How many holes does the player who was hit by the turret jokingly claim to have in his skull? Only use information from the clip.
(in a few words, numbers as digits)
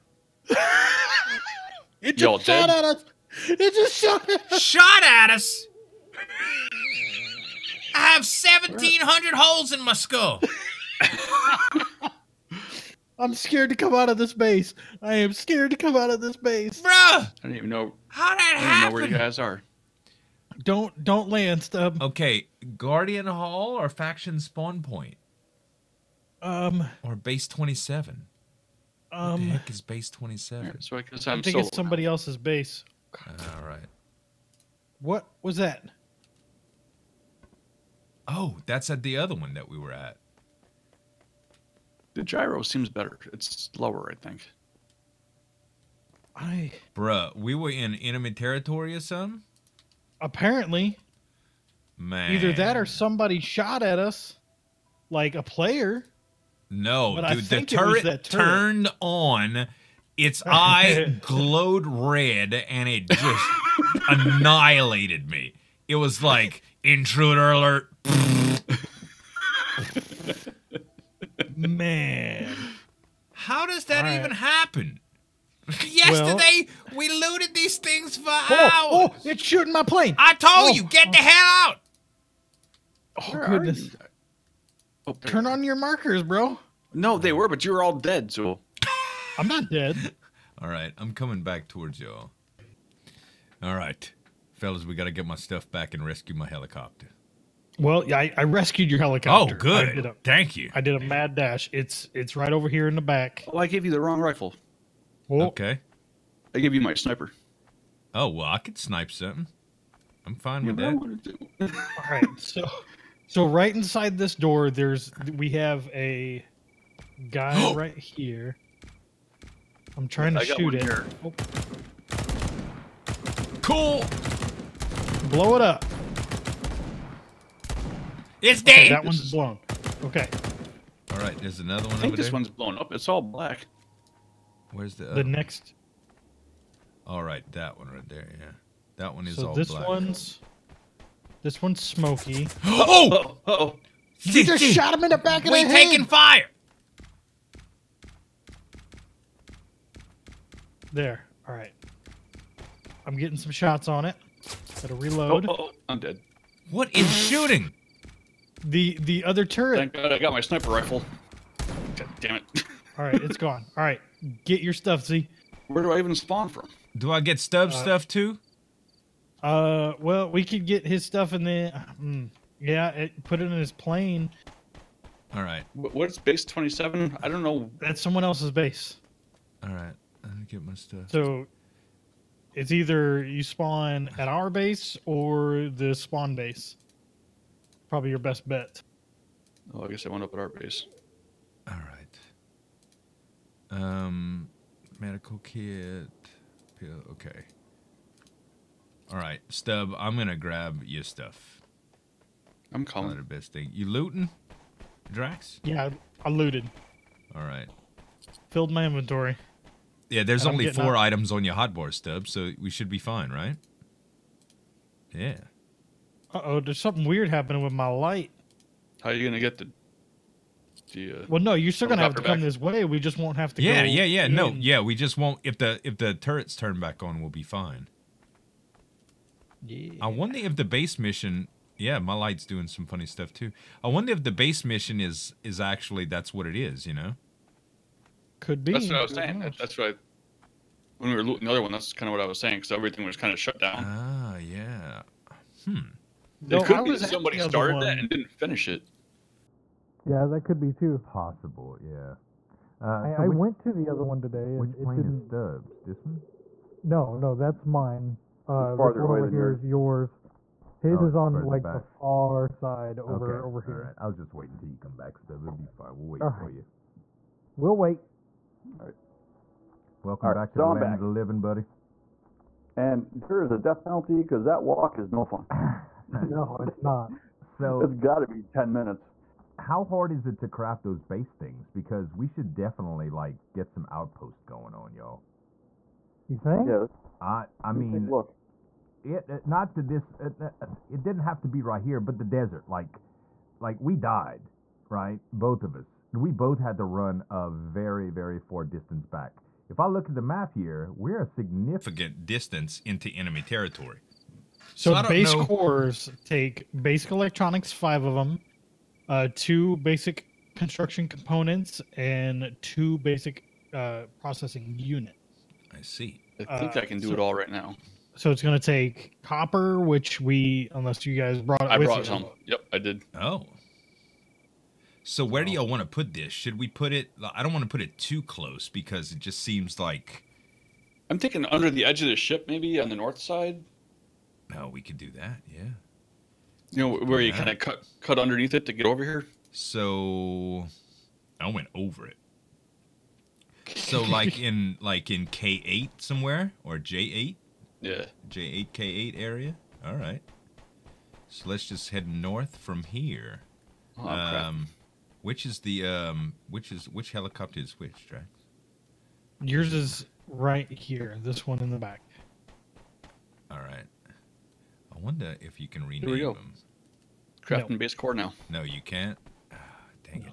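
1,700.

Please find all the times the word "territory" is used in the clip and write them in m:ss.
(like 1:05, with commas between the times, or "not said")
0:48, 5:03.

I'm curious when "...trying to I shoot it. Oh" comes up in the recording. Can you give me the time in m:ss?
2:00.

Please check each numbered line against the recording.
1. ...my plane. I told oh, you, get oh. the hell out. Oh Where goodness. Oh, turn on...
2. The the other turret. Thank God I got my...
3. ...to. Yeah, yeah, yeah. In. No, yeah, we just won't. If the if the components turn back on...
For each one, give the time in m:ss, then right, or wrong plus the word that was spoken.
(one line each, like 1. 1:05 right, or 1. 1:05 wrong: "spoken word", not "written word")
1. 1:19 right
2. 2:38 right
3. 3:43 wrong: "turrets", not "components".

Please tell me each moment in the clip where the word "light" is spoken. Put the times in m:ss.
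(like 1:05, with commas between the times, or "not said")
3:37, 3:52.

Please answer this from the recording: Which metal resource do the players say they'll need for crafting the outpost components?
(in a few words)
copper.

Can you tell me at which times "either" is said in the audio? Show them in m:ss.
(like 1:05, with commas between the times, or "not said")
0:52, 3:02.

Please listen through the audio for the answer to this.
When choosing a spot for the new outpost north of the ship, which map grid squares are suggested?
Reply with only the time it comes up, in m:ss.
5:48.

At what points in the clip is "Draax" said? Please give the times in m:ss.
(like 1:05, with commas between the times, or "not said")
3:25, 5:58.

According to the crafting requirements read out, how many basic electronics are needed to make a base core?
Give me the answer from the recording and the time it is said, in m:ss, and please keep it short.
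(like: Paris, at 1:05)
5, at 5:07.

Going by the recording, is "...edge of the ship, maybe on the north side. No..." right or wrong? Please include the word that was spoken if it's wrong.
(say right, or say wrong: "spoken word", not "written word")
right.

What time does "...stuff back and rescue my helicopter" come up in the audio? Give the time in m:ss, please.
1:35.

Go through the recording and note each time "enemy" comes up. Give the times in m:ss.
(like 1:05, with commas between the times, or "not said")
0:47, 5:03.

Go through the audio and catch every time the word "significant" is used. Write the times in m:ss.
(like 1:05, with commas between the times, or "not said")
5:01.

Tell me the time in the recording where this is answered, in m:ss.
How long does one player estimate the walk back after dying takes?
4:38.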